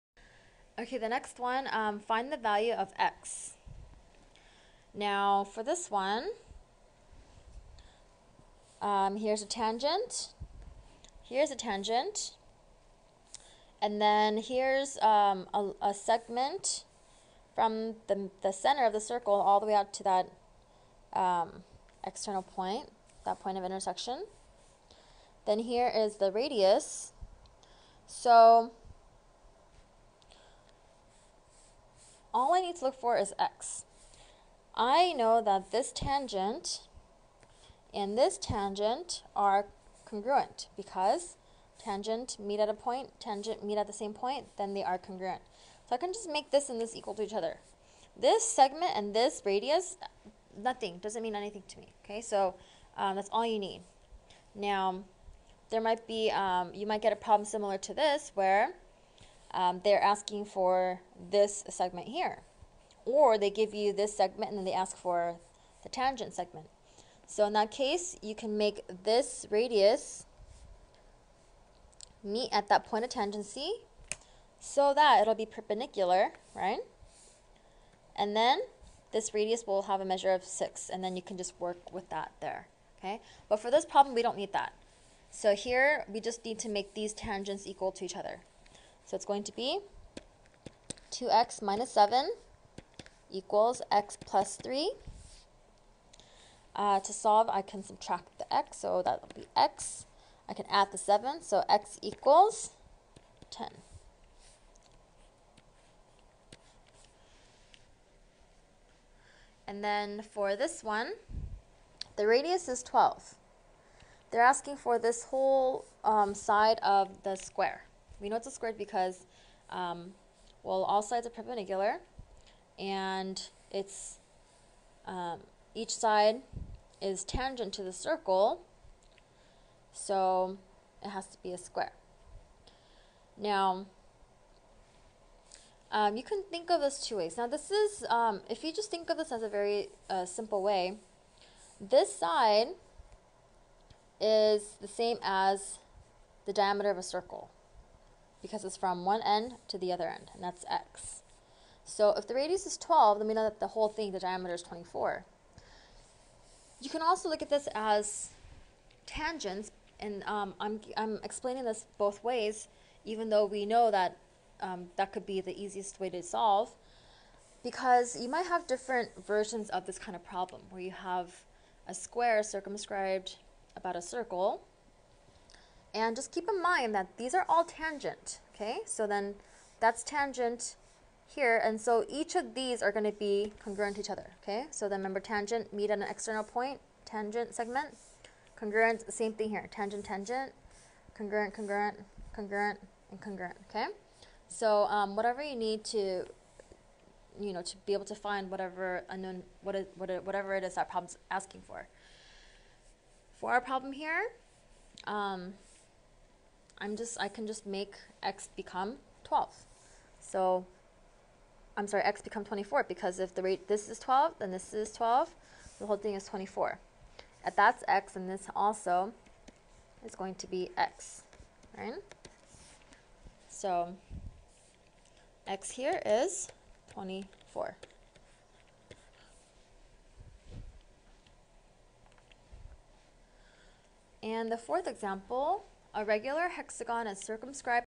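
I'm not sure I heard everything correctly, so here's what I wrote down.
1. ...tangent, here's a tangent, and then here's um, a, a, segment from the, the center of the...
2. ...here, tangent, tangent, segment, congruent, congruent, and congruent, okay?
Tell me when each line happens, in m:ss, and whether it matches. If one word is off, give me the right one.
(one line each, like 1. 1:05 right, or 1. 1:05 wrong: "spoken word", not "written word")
1. 0:09 right
2. 3:09 wrong: "congruent", not "segment".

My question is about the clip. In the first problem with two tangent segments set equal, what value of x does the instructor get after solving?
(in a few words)
10.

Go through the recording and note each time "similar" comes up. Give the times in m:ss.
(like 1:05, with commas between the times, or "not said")
0:57.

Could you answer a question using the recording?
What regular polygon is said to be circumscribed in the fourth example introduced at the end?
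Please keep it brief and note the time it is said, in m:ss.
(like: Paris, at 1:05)
hexagon, at 3:56.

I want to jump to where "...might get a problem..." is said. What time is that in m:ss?
0:56.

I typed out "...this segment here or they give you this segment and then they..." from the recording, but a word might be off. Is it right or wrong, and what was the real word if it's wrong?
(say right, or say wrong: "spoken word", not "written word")
right.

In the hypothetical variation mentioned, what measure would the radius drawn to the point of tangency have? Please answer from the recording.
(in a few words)
6.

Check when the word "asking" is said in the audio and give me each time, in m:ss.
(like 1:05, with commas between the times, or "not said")
1:00, 1:54, 3:21.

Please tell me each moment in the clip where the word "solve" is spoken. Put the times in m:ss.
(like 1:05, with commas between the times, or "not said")
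1:37, 2:46.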